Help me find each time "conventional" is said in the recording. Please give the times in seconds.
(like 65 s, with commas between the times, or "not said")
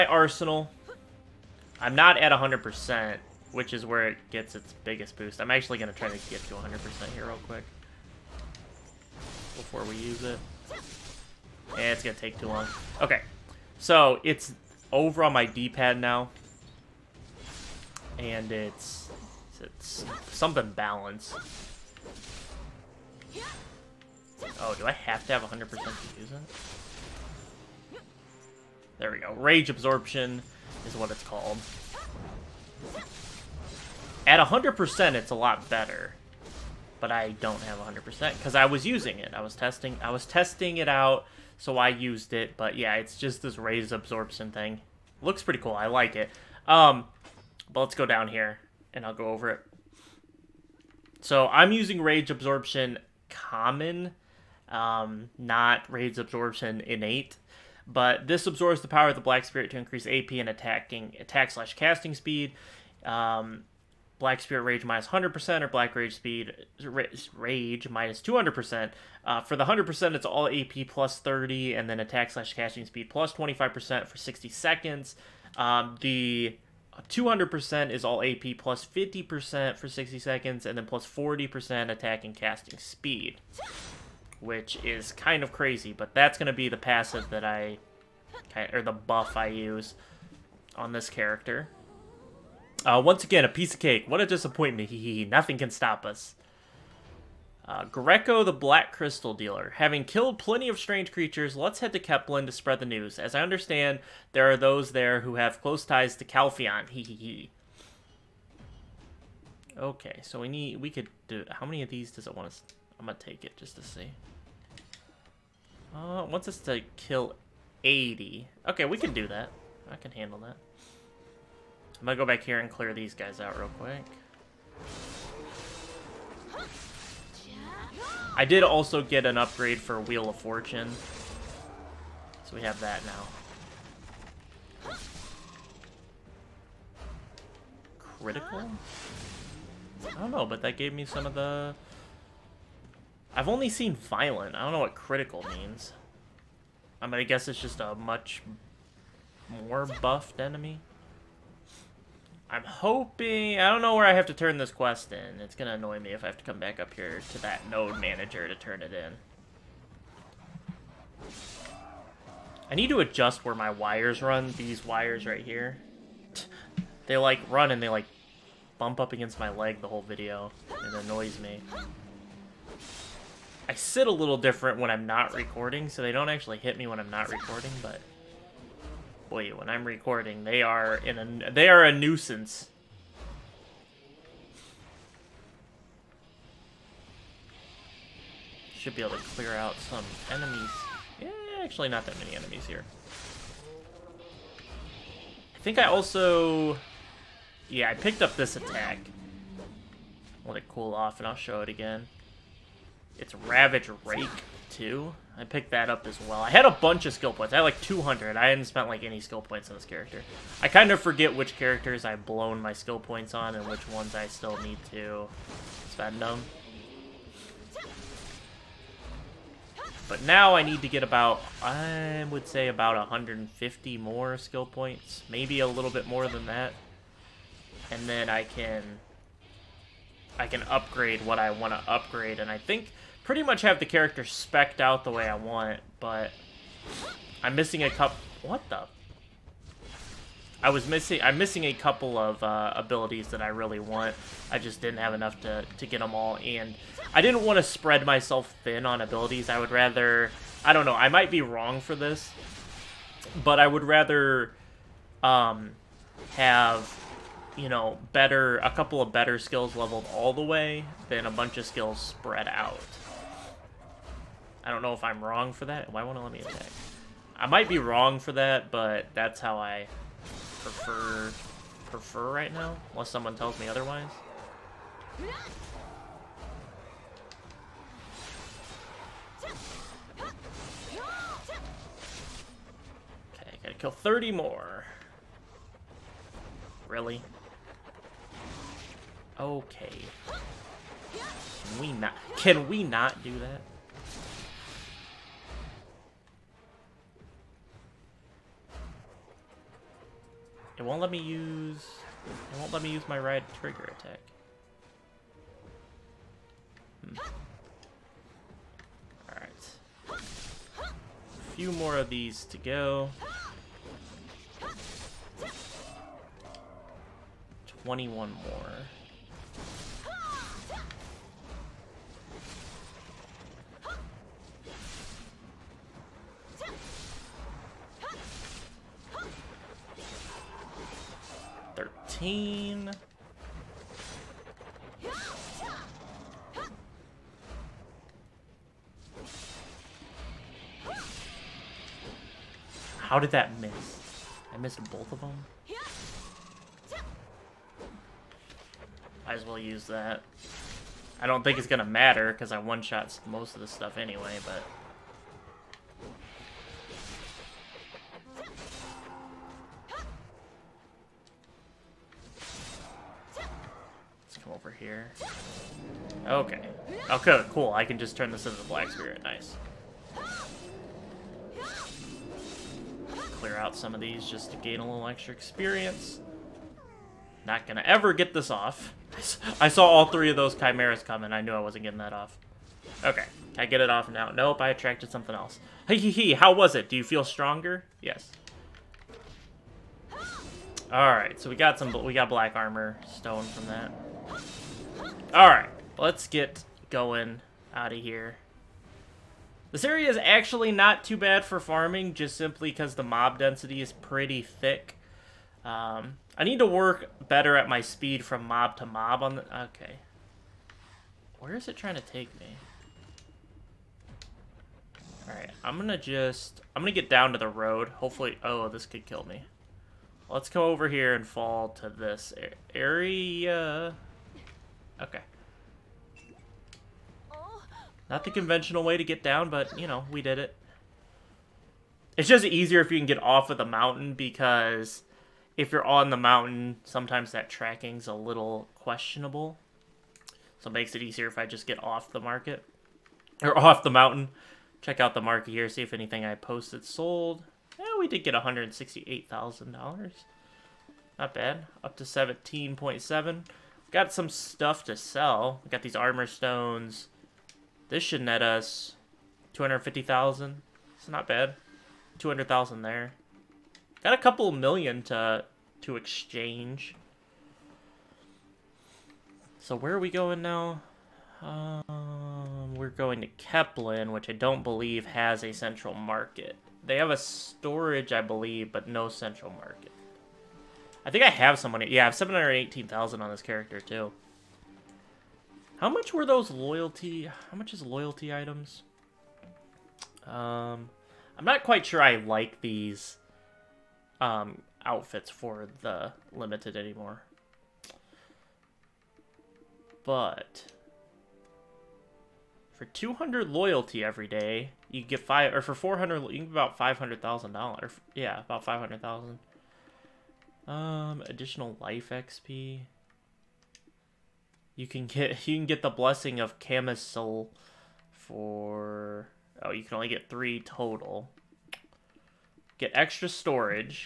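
428 s.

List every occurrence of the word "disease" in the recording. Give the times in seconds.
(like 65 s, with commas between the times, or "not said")
not said.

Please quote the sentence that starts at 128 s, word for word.
I did also get an upgrade for Wheel of Fortune.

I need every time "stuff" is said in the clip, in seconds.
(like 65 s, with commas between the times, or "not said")
353 s, 454 s.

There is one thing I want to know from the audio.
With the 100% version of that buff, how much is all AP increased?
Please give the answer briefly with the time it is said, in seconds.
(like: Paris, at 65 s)
30, at 70 s.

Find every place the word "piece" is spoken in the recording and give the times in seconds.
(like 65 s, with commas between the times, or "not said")
93 s.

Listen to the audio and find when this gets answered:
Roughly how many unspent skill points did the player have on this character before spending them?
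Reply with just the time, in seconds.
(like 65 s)
207 s.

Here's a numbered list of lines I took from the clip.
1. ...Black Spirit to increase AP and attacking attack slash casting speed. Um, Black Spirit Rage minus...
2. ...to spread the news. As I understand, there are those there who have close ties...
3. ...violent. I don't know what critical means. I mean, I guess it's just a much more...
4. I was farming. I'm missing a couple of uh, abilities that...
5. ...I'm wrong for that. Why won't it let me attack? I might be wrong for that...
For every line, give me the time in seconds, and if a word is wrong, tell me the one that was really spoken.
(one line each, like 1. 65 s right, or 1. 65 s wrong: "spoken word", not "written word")
1. 59 s right
2. 102 s right
3. 143 s right
4. 240 s wrong: "missing", not "farming"
5. 265 s right.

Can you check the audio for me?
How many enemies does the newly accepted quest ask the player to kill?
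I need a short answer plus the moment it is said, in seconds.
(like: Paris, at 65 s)
80, at 116 s.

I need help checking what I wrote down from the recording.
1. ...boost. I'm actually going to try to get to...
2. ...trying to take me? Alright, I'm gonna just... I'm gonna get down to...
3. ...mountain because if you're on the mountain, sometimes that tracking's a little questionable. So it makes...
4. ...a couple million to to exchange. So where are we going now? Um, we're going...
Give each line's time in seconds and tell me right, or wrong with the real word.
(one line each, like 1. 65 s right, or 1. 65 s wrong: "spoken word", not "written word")
1. 5 s right
2. 411 s right
3. 433 s right
4. 464 s right.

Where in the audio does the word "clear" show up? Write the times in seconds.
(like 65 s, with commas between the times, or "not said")
122 s, 189 s, 373 s.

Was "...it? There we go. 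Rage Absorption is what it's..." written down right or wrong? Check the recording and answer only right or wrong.
right.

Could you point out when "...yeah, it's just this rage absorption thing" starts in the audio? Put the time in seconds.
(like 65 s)
42 s.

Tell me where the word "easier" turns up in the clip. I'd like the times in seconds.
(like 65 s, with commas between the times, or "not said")
432 s, 441 s.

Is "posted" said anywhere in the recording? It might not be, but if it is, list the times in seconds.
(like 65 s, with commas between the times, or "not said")
446 s.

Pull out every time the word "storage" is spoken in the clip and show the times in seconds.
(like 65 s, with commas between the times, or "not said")
477 s, 523 s.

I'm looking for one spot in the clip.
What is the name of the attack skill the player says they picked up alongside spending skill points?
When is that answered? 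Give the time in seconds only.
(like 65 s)
203 s.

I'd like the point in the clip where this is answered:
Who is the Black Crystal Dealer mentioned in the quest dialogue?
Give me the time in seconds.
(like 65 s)
97 s.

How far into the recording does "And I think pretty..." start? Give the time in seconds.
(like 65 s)
232 s.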